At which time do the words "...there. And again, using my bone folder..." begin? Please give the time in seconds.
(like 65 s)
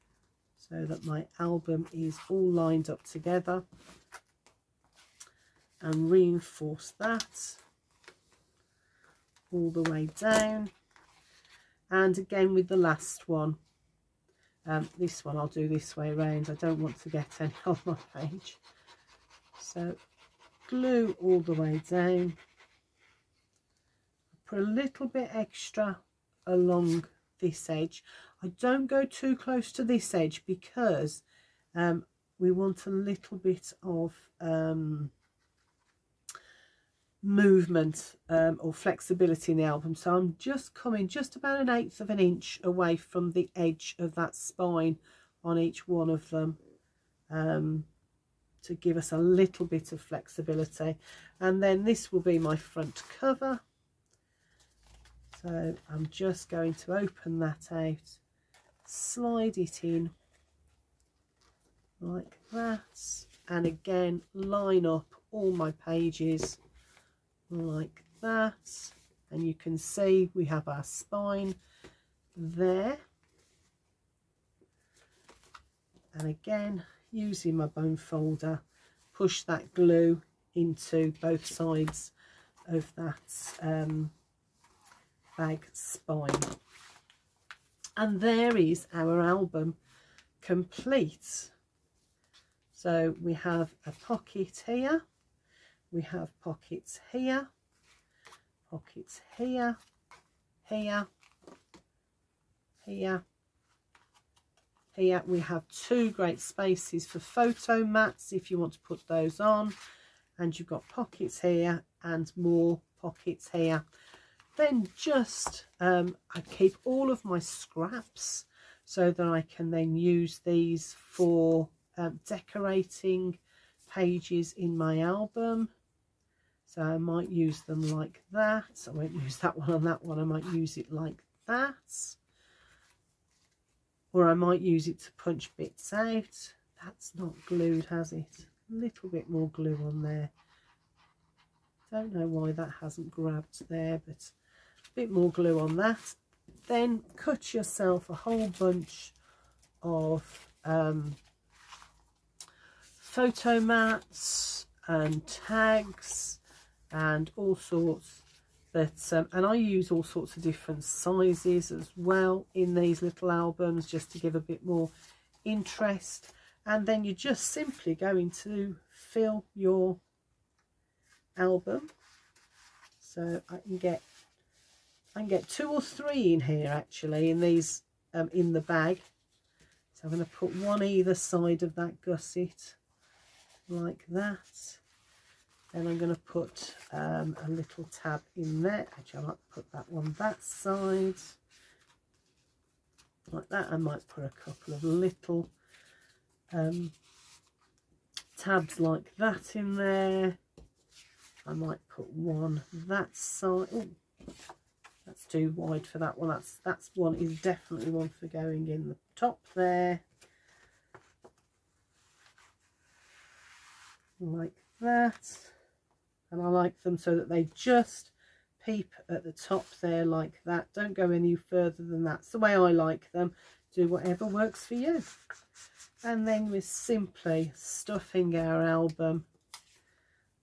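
72 s.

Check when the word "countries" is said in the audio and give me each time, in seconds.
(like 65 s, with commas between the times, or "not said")
not said.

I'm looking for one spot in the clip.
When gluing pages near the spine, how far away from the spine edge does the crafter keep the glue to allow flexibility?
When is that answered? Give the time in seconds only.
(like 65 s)
41 s.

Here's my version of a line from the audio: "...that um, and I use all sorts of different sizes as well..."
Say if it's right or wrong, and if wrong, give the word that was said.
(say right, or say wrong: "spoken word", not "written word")
right.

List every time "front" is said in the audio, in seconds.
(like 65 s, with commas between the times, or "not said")
52 s.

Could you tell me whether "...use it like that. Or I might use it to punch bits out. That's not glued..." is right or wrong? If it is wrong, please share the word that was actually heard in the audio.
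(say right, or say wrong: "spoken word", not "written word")
right.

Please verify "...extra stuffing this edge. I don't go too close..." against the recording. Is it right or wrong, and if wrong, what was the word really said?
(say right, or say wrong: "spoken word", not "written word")
wrong: "along", not "stuffing".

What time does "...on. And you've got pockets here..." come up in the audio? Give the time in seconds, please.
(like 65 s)
109 s.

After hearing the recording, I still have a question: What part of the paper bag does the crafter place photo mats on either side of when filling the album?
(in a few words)
gusset.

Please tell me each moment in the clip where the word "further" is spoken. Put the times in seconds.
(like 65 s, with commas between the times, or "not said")
221 s.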